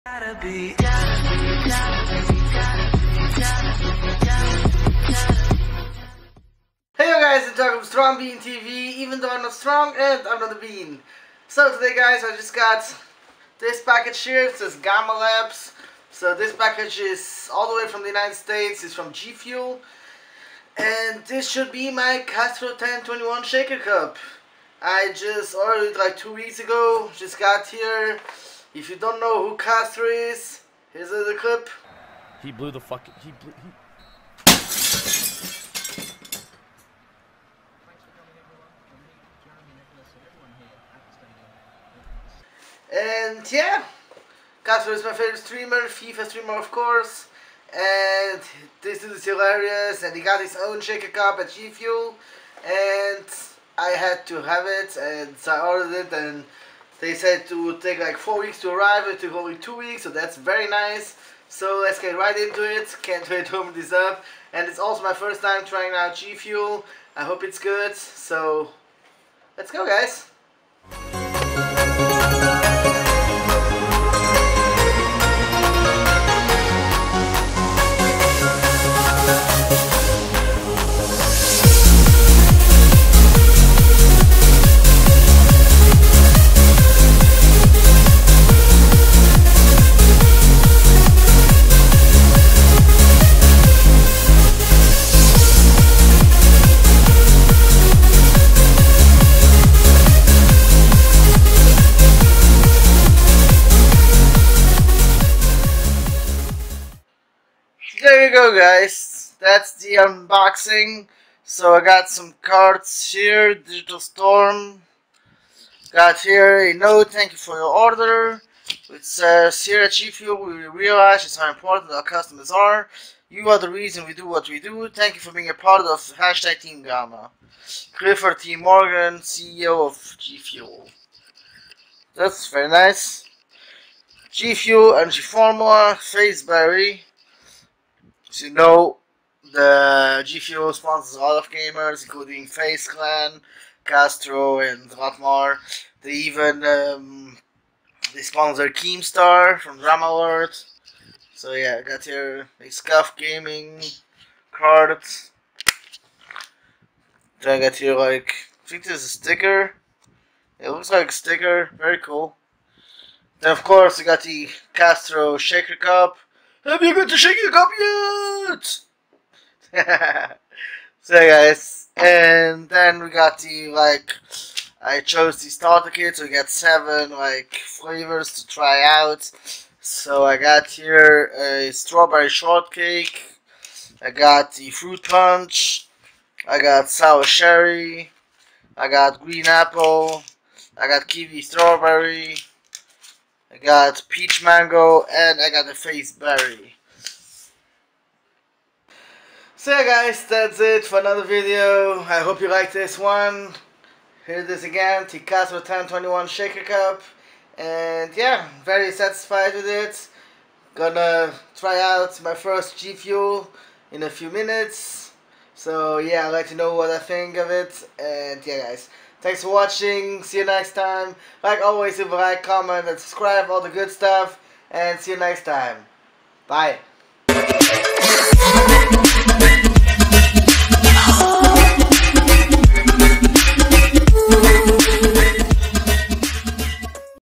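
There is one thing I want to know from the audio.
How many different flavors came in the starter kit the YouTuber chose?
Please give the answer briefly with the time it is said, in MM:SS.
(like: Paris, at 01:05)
7, at 02:56.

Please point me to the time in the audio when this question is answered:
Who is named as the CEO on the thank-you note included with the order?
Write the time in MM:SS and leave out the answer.
02:07.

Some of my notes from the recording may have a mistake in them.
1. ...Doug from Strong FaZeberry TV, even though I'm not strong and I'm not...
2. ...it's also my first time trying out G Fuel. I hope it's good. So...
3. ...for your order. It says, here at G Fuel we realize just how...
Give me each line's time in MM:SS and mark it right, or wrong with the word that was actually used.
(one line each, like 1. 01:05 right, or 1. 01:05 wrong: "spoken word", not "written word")
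1. 00:07 wrong: "Bean", not "FaZeberry"
2. 01:04 right
3. 01:57 right.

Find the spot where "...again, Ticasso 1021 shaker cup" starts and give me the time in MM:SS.
03:24.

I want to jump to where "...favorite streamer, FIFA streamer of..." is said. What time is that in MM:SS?
00:45.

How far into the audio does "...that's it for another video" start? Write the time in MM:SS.
03:20.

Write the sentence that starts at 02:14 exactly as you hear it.
G Fuel Energy Formula, FaZeberry, as you know, the G Fuel sponsors a lot of gamers, including FaZe Clan, Castro, and more.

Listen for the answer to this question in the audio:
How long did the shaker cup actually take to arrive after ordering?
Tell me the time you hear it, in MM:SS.
00:59.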